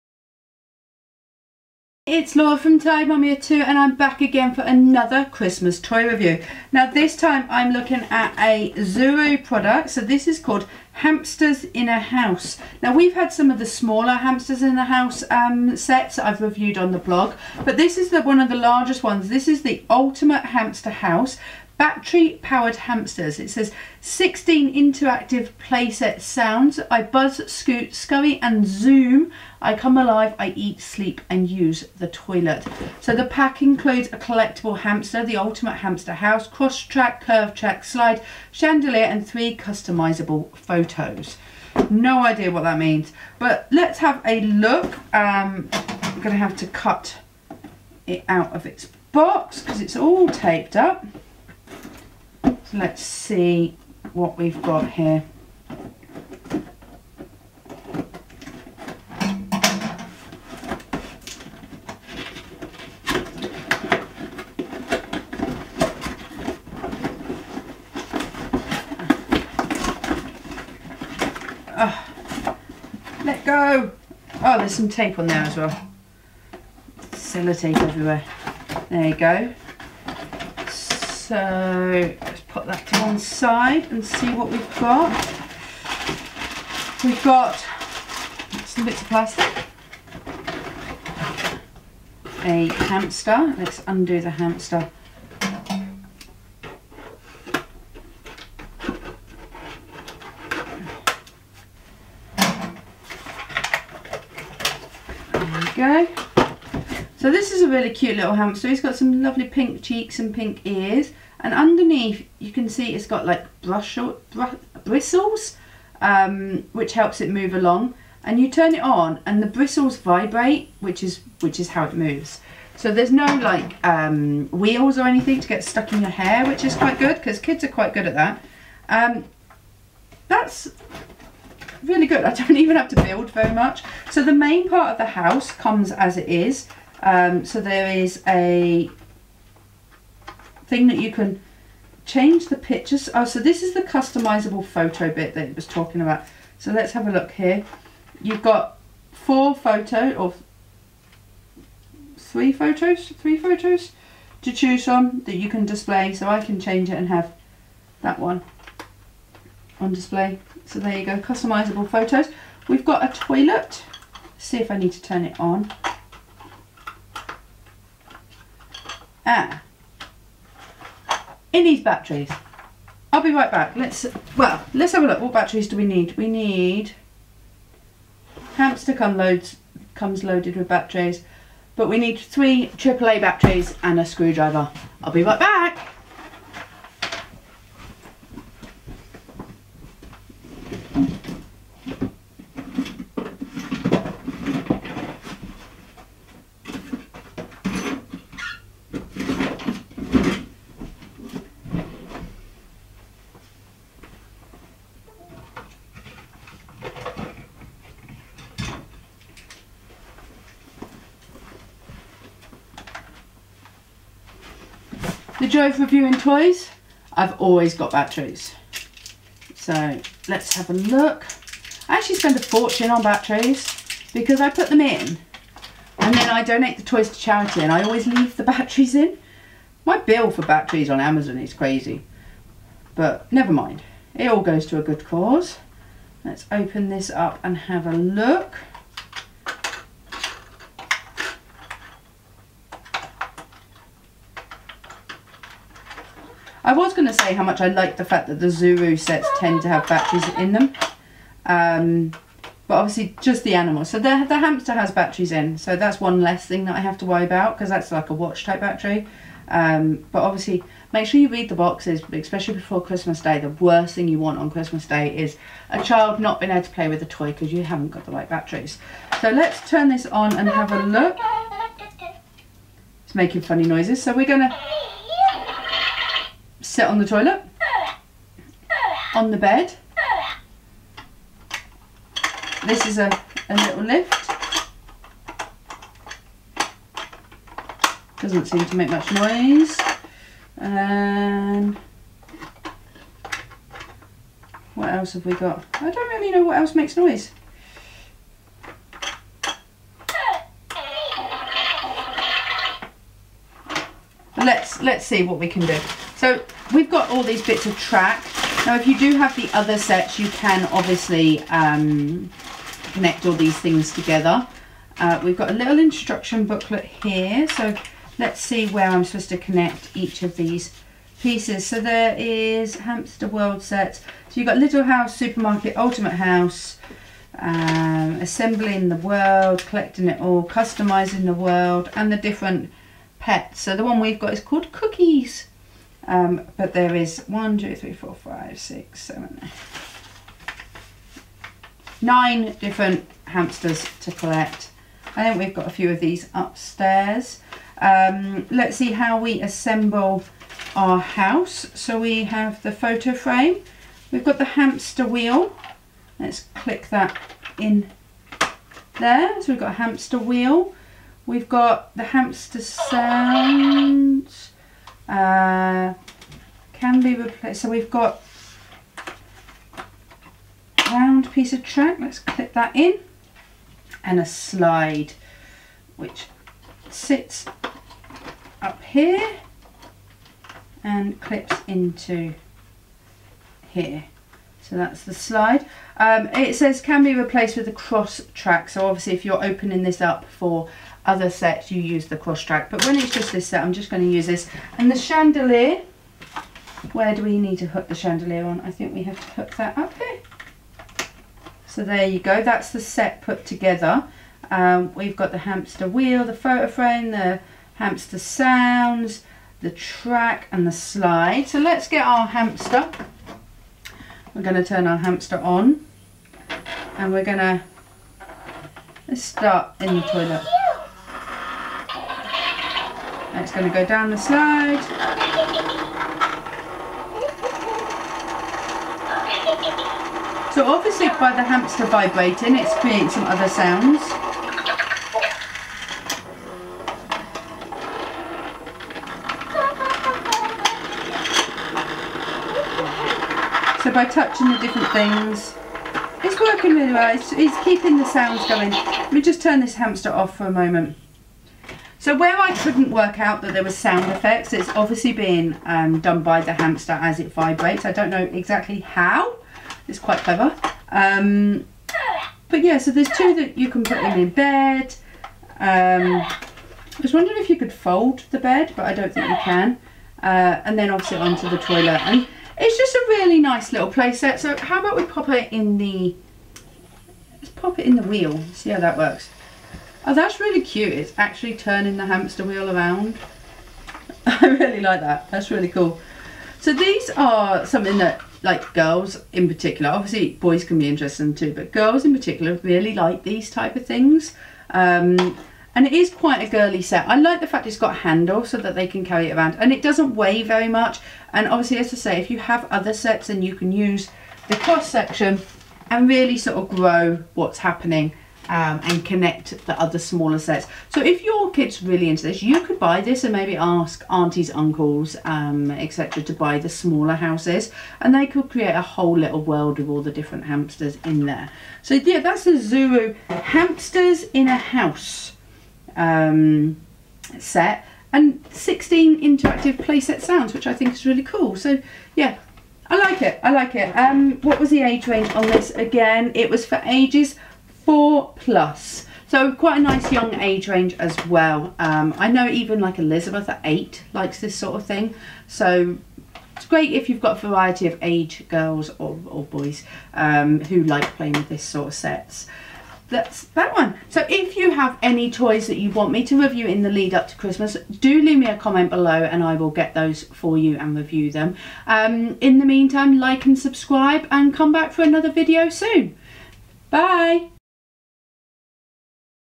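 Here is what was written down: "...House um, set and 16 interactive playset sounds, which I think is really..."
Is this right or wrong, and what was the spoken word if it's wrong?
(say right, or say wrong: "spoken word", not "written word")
right.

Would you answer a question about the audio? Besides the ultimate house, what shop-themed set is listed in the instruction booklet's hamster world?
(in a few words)
supermarket.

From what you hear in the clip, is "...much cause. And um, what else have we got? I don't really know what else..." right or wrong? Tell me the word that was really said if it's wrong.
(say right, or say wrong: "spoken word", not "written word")
wrong: "noise", not "cause".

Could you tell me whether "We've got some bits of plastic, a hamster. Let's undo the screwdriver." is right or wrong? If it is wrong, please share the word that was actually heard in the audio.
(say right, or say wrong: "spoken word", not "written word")
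wrong: "hamster", not "screwdriver".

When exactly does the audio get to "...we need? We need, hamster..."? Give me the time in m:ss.
2:55.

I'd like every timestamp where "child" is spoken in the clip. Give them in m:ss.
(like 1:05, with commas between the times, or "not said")
4:25.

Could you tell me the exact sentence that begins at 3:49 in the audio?
My bill for batteries on Amazon is crazy, but never mind.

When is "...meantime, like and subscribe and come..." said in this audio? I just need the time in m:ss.
9:22.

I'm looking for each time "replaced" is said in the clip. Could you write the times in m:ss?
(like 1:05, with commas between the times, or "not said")
6:07, 6:27.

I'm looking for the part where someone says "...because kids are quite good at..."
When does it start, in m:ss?
2:07.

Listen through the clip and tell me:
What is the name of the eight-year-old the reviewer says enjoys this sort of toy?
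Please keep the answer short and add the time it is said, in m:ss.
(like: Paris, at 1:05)
Elizabeth, at 9:02.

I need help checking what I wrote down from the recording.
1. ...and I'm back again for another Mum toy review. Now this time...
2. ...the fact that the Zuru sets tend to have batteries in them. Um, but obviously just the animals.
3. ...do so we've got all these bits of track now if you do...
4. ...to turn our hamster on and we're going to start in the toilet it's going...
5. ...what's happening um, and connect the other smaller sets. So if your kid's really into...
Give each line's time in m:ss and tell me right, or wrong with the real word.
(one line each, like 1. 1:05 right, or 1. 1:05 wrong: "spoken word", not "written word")
1. 0:03 wrong: "Christmas", not "Mum"
2. 4:07 right
3. 5:05 right
4. 6:54 right
5. 8:27 right.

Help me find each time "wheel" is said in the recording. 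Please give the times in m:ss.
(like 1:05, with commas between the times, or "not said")
2:04, 5:55, 6:00, 6:45, 7:58, 8:02.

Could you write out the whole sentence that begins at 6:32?
But when it's just this set, I'm just going to use this.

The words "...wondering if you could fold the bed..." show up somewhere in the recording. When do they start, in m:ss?
7:47.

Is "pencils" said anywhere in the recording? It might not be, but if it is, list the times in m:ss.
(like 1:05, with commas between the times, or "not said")
not said.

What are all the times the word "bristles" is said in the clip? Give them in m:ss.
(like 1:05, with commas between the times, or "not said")
1:54, 1:59.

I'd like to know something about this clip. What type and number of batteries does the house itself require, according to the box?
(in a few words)
three AAA batteries.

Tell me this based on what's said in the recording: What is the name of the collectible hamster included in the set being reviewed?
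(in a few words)
Cookies.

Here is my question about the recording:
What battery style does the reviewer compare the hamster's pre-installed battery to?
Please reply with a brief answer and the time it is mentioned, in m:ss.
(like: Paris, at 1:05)
watch type battery, at 4:18.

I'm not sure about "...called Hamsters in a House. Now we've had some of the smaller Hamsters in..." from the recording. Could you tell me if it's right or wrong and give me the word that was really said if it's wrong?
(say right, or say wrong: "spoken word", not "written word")
right.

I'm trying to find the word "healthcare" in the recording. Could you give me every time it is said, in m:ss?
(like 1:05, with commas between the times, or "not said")
not said.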